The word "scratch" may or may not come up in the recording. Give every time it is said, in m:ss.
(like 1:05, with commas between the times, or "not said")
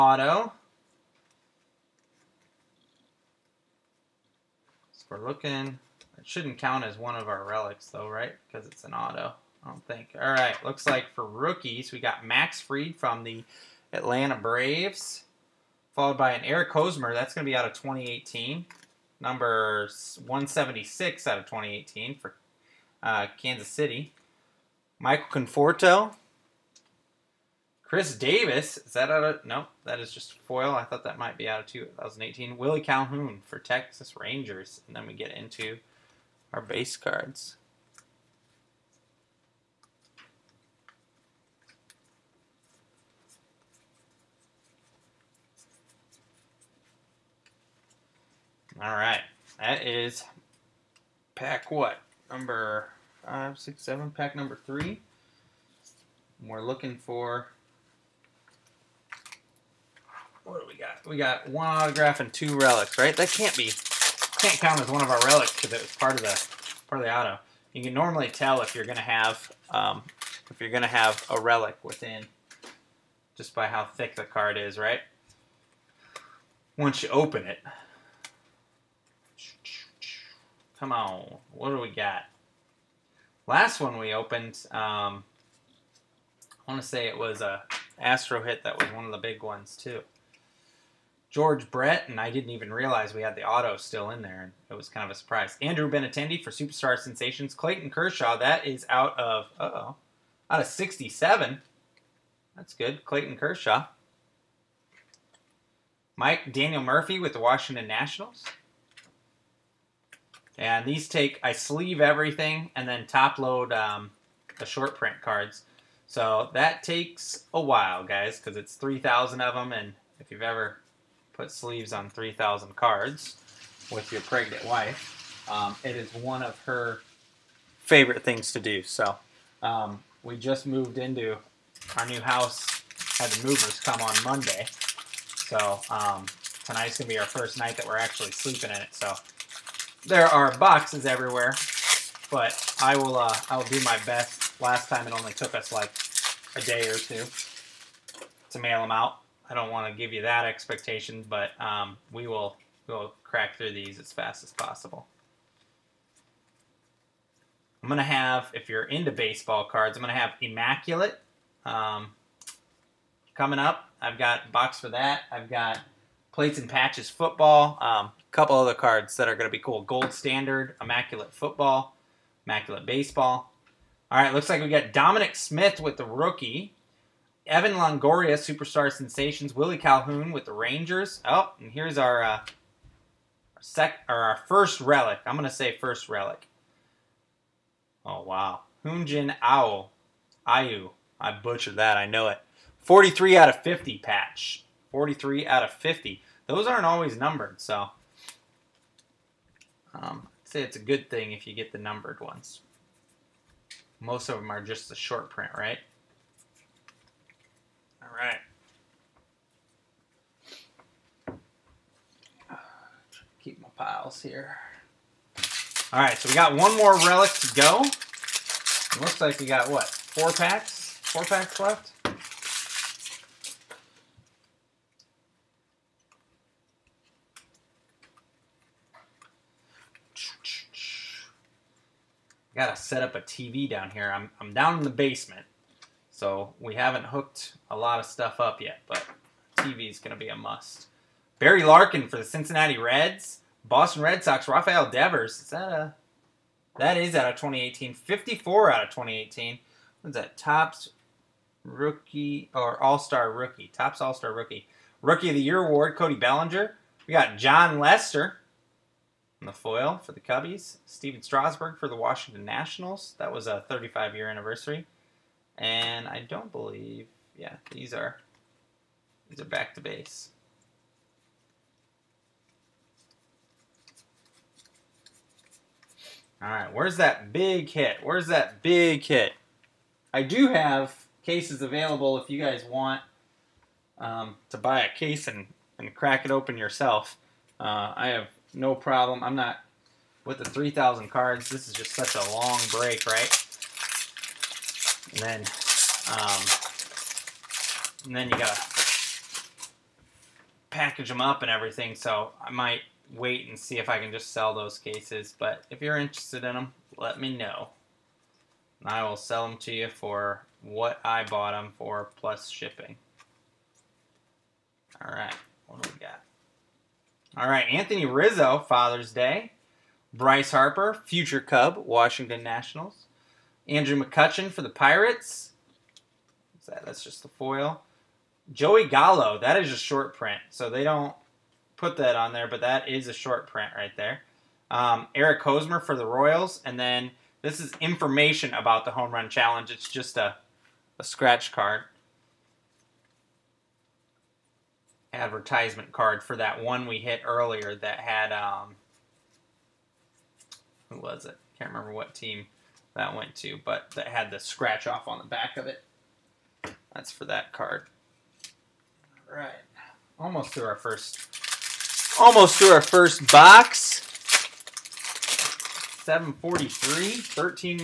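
5:41, 5:54.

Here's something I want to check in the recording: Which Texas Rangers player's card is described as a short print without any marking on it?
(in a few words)
Joey Gallo.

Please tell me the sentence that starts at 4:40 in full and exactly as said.
I do have cases available if you guys want um, to buy a case and, and crack it open yourself.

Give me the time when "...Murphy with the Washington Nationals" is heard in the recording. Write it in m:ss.
1:46.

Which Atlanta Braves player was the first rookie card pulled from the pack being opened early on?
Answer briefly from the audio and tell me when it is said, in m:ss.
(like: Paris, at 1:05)
Max Fried, at 0:12.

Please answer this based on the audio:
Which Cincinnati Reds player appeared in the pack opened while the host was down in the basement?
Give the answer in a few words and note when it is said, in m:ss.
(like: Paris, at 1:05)
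Barry Larkin, at 4:01.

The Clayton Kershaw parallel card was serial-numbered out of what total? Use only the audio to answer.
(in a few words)
67.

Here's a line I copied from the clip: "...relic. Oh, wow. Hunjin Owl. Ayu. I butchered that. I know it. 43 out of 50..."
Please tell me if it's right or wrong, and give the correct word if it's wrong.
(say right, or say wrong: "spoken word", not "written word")
right.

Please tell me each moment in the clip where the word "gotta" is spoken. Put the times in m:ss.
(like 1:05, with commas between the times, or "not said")
3:52, 4:58.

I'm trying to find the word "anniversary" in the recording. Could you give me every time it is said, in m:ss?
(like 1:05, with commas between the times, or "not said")
4:24.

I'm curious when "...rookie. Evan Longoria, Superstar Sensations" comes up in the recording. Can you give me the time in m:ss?
2:56.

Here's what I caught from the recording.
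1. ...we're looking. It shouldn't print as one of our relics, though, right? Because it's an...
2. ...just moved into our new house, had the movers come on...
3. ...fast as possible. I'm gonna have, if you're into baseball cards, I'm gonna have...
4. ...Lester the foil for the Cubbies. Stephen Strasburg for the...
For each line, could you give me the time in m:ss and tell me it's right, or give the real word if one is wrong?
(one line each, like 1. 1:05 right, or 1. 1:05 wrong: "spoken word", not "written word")
1. 0:05 wrong: "count", not "print"
2. 2:10 right
3. 2:34 right
4. 4:17 right.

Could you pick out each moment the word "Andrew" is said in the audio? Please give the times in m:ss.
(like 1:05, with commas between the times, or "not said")
1:35, 5:23.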